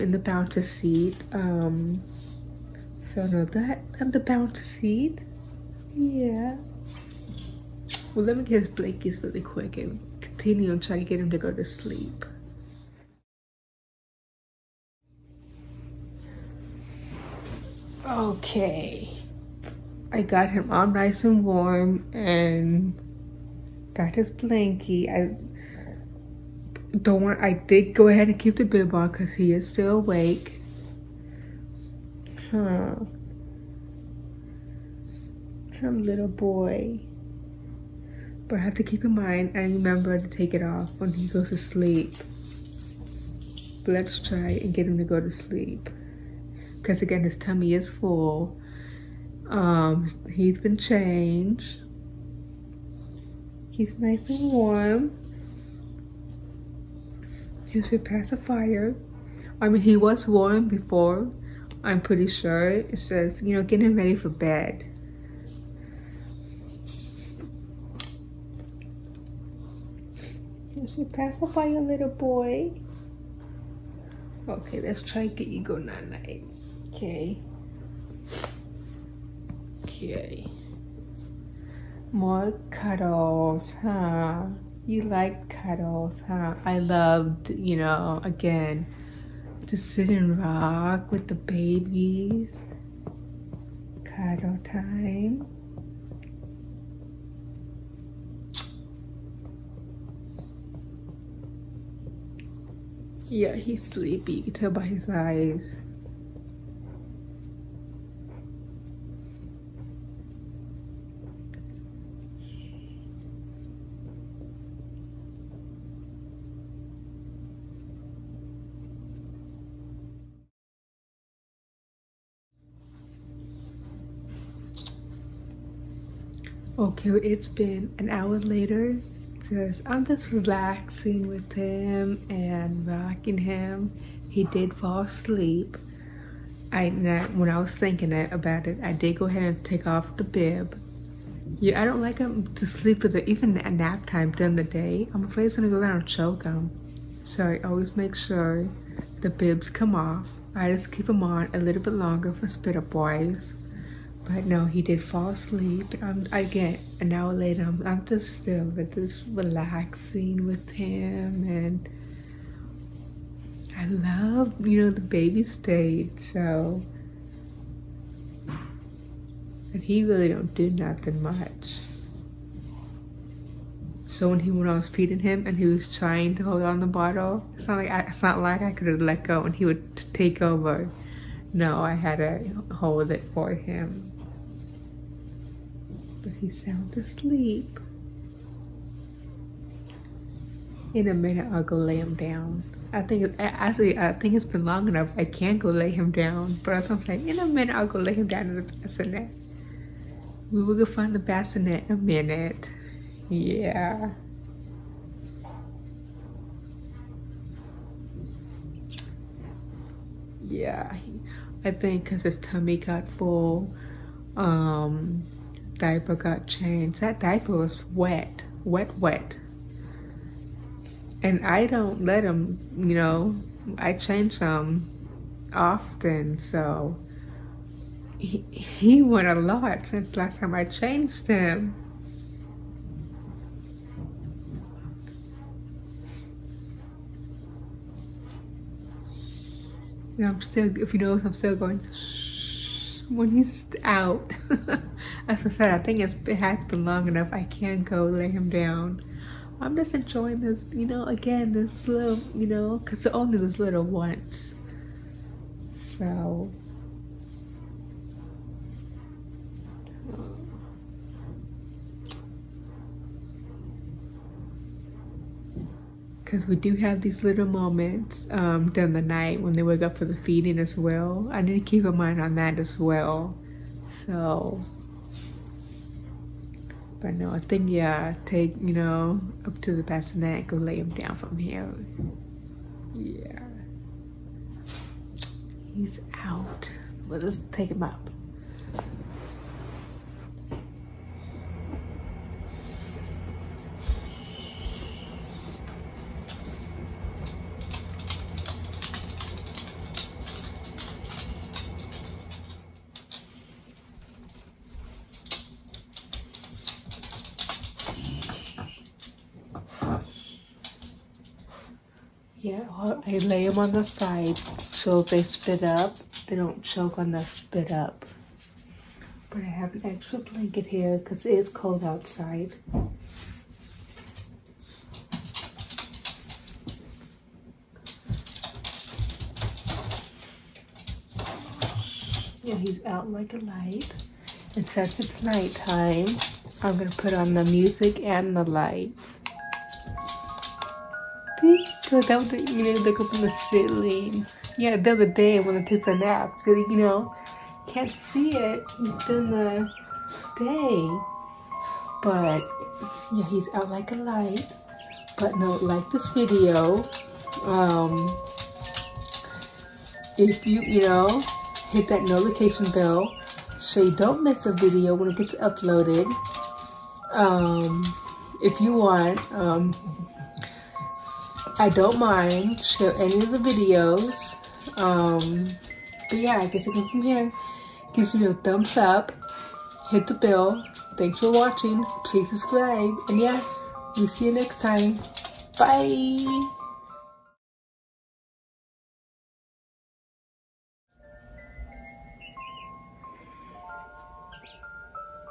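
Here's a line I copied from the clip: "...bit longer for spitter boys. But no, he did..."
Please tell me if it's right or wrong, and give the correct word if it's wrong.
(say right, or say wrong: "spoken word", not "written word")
right.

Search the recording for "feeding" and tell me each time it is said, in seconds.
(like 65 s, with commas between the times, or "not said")
174 s, 270 s.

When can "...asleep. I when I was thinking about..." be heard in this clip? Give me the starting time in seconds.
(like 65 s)
135 s.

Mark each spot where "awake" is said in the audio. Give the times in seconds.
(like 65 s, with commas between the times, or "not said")
29 s.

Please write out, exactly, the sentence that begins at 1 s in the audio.
Um, so no, that and the bouncer seat.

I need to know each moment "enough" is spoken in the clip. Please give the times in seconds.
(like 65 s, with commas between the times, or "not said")
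194 s, 247 s.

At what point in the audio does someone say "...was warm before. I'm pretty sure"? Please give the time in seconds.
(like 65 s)
59 s.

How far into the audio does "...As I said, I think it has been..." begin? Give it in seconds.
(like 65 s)
245 s.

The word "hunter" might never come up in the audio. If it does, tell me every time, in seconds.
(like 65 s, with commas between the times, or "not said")
not said.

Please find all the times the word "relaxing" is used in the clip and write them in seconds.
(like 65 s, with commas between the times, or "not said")
130 s, 159 s.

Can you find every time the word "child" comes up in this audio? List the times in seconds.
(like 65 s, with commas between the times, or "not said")
not said.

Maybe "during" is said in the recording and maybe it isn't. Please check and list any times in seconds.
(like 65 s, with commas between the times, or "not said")
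144 s, 268 s.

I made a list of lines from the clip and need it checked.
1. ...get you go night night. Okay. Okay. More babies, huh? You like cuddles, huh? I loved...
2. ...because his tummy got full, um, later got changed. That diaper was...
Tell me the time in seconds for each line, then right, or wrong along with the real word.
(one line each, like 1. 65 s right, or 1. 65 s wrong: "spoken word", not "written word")
1. 75 s wrong: "cuddles", not "babies"
2. 212 s wrong: "diaper", not "later".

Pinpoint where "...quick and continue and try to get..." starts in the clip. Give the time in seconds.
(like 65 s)
9 s.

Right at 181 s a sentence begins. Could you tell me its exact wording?
No, I had to hold it for him but he's sound asleep.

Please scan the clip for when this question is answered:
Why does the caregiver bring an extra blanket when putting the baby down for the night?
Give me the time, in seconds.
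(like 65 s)
321 s.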